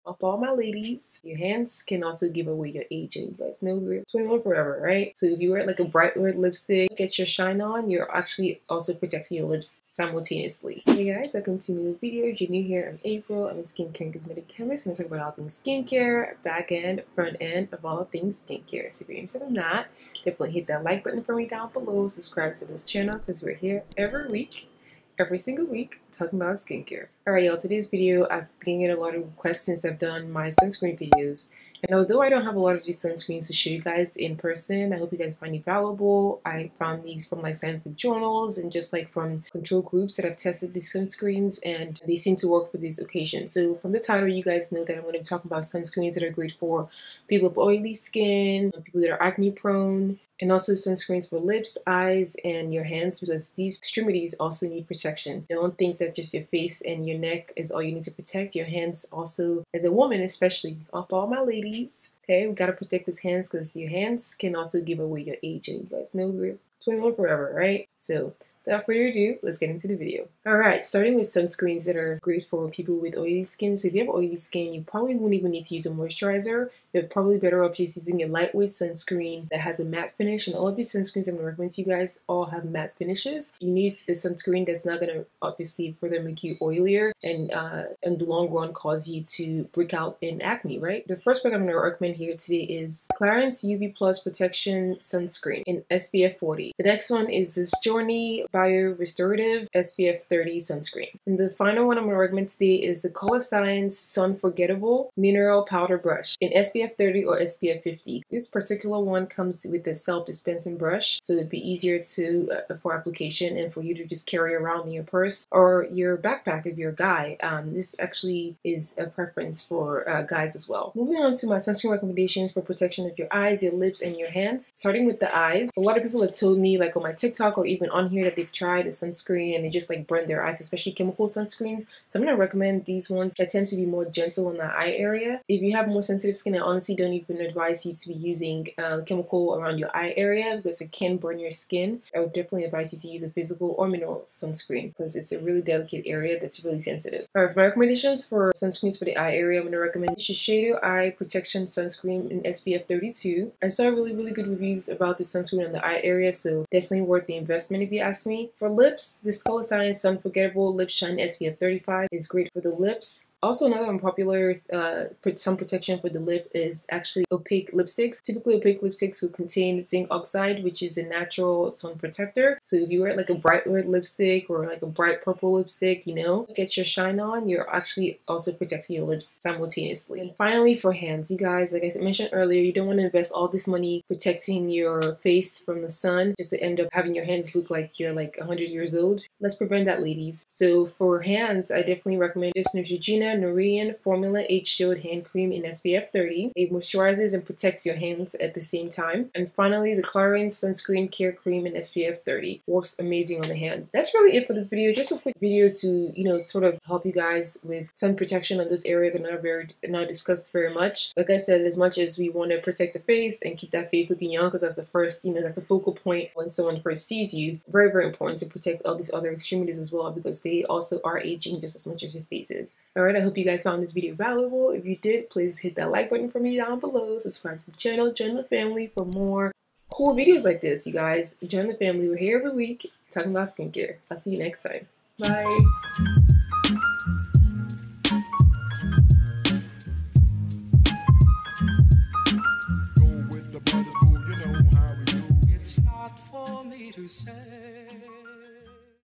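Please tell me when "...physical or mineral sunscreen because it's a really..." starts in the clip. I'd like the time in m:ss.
2:23.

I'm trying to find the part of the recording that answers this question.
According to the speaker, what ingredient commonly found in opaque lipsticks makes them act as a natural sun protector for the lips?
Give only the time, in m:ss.
2:49.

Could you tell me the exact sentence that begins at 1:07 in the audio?
So Without further ado, let's get into the video.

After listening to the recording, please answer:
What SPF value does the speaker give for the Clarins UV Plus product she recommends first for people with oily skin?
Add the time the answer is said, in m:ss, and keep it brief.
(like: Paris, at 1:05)
SPF 40, at 1:35.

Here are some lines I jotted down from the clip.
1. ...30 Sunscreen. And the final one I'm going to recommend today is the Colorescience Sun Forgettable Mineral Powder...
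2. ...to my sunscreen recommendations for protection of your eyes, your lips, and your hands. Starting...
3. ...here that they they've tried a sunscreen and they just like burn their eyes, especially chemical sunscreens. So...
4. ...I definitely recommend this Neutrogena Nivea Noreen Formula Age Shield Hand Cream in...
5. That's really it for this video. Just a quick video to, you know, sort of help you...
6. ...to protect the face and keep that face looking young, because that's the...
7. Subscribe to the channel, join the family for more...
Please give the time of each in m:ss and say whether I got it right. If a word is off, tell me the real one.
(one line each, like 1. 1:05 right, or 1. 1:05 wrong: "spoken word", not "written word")
1. 1:40 right
2. 2:01 right
3. 2:08 right
4. 3:11 right
5. 3:23 right
6. 3:32 right
7. 3:47 right.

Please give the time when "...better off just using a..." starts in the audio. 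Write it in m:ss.
1:17.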